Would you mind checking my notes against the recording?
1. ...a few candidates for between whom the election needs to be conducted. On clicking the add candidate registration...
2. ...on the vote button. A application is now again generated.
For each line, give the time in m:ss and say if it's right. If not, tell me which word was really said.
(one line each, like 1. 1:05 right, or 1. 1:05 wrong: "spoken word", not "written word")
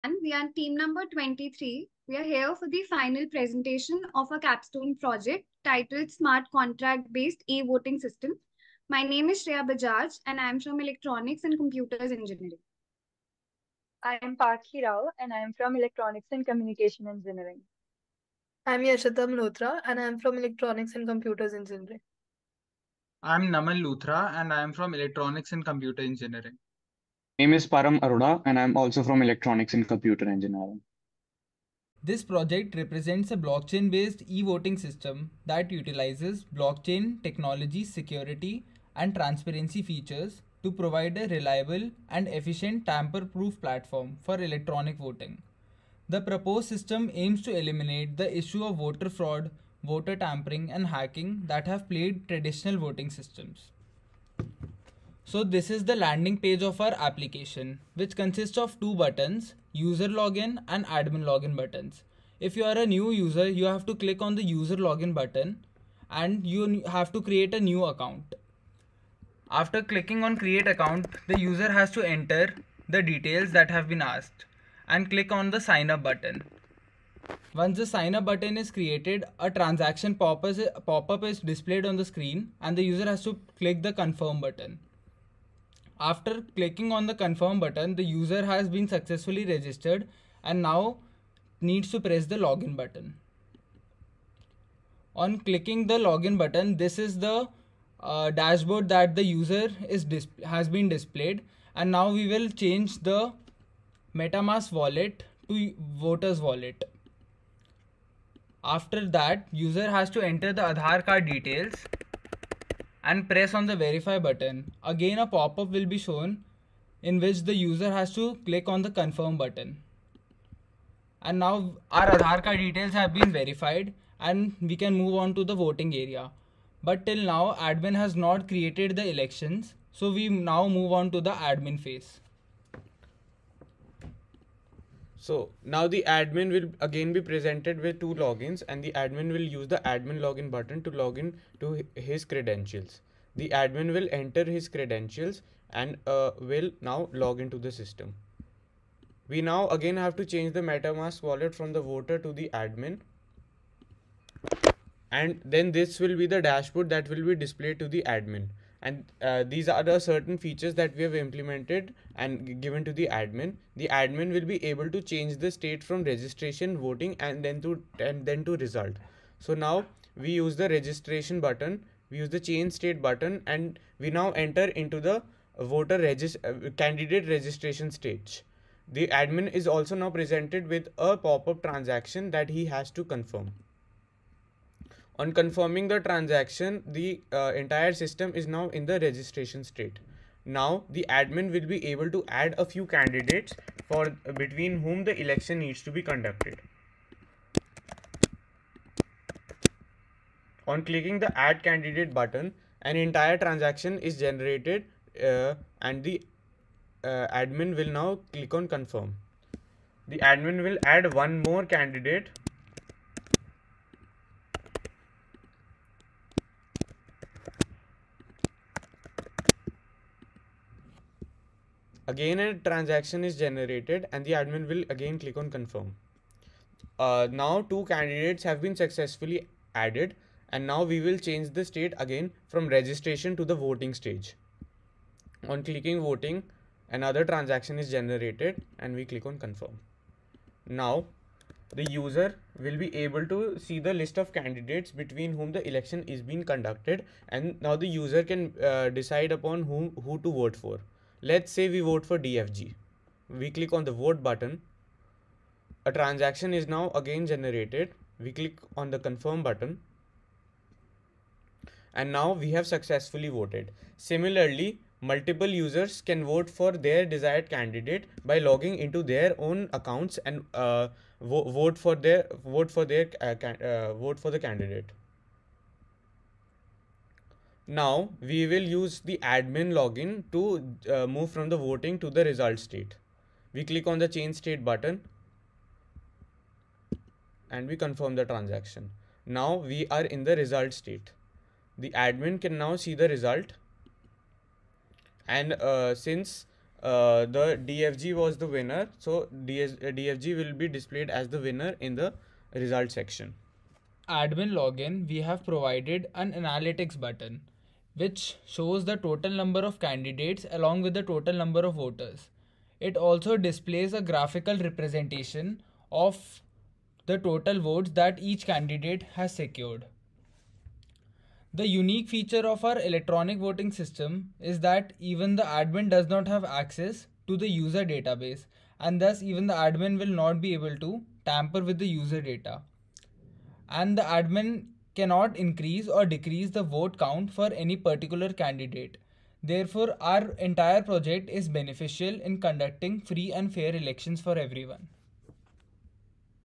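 1. 3:12 wrong: "button", not "registration"
2. 4:13 wrong: "transaction", not "application".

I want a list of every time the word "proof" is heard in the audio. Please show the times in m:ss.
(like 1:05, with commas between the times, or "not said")
0:43.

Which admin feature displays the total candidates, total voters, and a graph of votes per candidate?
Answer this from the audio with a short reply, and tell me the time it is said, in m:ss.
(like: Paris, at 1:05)
analytics button, at 5:06.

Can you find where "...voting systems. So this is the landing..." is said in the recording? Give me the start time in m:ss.
0:52.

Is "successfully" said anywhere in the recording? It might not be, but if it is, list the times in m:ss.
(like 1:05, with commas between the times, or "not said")
1:28, 3:48, 4:22.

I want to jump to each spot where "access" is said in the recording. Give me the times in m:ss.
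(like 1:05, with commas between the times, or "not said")
5:26.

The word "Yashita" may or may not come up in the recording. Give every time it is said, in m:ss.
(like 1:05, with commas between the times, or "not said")
0:18.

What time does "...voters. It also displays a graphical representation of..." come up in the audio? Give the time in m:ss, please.
5:11.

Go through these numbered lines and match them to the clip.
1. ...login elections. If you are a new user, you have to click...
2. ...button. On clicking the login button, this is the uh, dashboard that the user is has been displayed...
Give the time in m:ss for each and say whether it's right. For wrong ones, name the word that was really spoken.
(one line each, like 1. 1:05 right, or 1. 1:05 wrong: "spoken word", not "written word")
1. 1:01 wrong: "buttons", not "elections"
2. 1:32 right.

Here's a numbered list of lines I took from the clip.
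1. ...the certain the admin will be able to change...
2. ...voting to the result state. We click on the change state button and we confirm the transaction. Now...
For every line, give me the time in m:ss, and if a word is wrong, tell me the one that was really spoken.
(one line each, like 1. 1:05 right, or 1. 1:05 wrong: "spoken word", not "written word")
1. 2:42 wrong: "admin", not "certain"
2. 4:41 right.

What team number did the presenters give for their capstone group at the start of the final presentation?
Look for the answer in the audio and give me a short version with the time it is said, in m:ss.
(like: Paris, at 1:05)
23, at 0:00.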